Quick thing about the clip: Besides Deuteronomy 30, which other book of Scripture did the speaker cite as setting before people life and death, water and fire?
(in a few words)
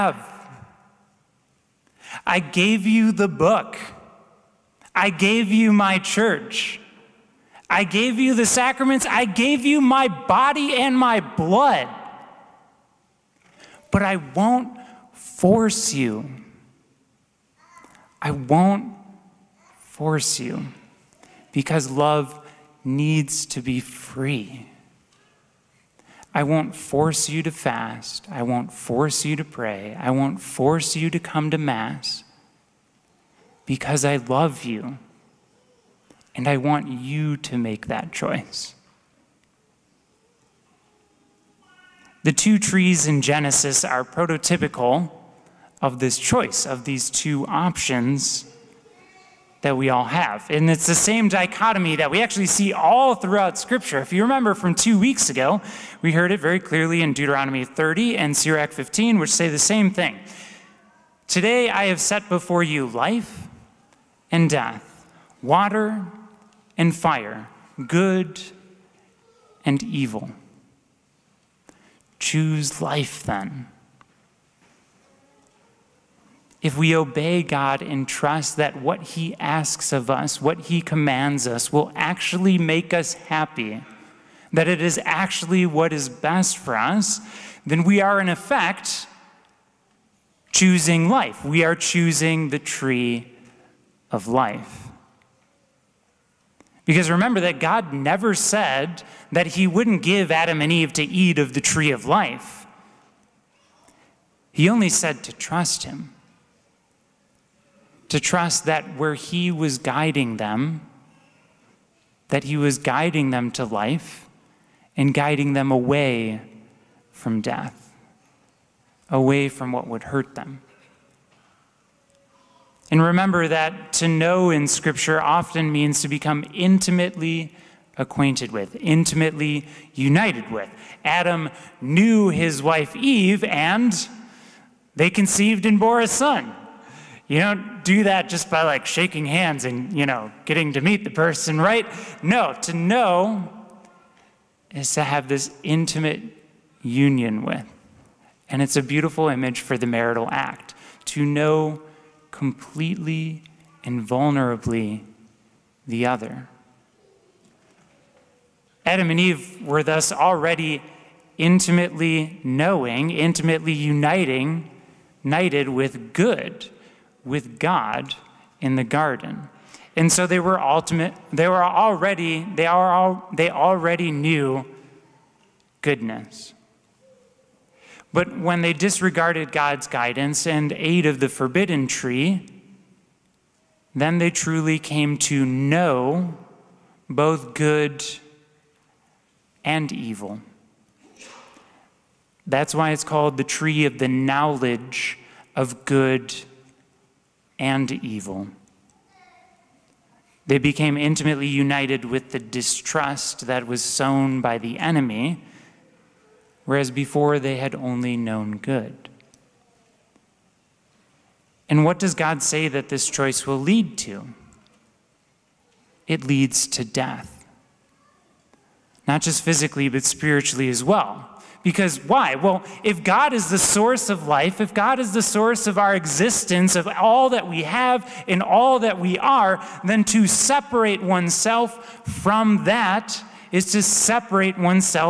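Sirach 15.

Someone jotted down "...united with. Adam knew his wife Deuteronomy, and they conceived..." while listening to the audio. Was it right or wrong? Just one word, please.
wrong.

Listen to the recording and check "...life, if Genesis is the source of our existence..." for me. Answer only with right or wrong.
wrong.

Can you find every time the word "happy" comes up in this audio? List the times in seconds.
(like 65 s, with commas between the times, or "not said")
83 s.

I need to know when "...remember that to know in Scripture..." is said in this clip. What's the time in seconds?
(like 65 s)
123 s.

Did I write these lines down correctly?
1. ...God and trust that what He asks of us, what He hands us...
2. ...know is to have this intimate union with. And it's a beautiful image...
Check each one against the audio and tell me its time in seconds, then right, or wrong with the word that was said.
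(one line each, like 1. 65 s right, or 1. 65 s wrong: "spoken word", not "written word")
1. 77 s wrong: "commands", not "hands"
2. 142 s right.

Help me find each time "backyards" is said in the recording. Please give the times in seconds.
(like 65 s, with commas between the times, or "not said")
not said.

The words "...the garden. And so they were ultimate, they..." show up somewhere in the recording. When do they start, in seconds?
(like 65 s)
168 s.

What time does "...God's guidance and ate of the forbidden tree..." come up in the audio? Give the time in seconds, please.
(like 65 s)
179 s.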